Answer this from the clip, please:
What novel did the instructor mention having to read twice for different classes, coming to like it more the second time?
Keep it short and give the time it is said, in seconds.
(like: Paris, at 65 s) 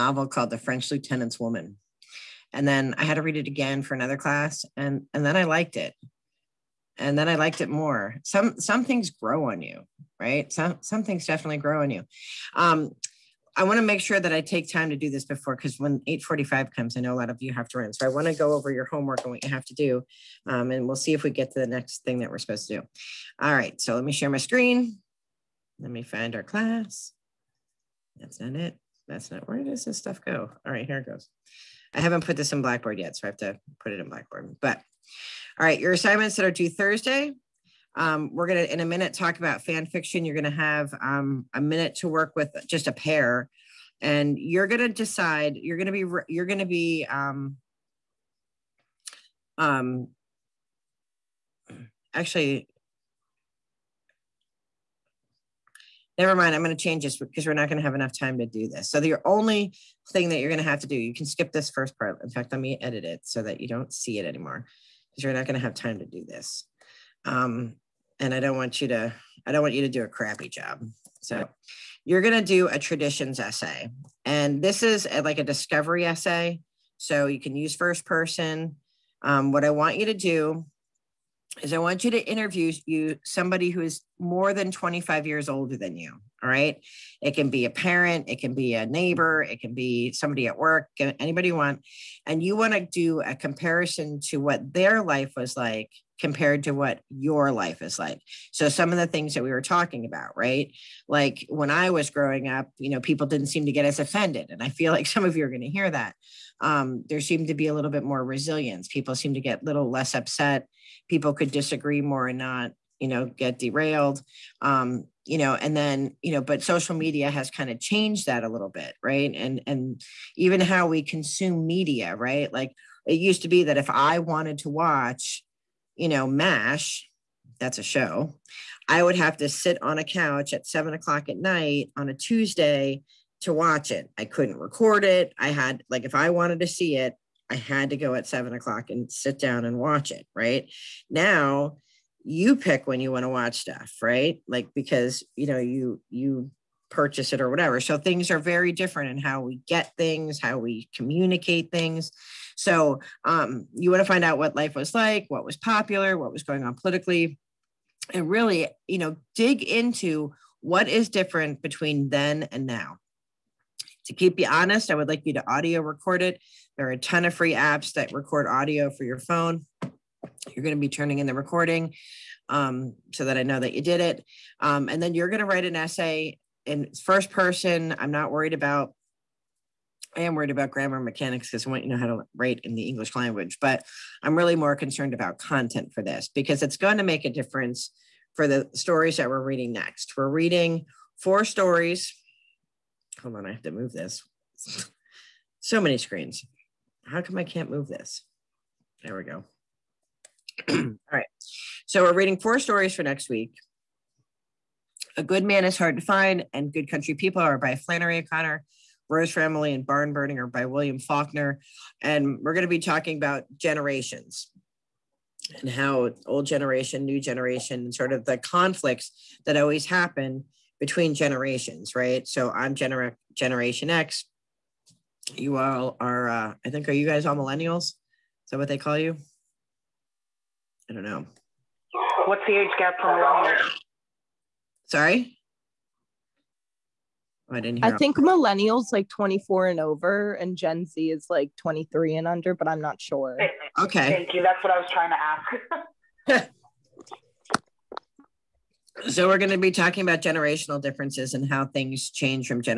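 The French Lieutenant's Woman, at 0 s.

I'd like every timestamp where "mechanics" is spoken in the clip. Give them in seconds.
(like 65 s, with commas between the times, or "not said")
180 s.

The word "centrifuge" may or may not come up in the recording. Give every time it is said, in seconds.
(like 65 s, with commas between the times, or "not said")
not said.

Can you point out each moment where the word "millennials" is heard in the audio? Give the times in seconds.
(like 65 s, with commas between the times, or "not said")
227 s, 233 s, 238 s.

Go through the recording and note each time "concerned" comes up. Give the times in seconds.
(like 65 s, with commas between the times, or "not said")
184 s.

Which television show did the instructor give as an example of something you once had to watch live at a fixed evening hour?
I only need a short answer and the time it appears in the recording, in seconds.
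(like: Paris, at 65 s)
MASH, at 126 s.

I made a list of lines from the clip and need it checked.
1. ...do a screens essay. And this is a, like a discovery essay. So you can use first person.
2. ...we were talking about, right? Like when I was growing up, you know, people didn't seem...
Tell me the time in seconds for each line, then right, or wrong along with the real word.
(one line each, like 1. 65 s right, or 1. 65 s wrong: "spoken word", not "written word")
1. 72 s wrong: "traditions", not "screens"
2. 99 s right.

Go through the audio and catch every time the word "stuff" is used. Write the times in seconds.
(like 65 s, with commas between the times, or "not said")
29 s, 143 s.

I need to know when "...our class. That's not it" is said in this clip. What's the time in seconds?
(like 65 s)
26 s.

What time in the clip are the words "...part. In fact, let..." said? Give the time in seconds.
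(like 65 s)
61 s.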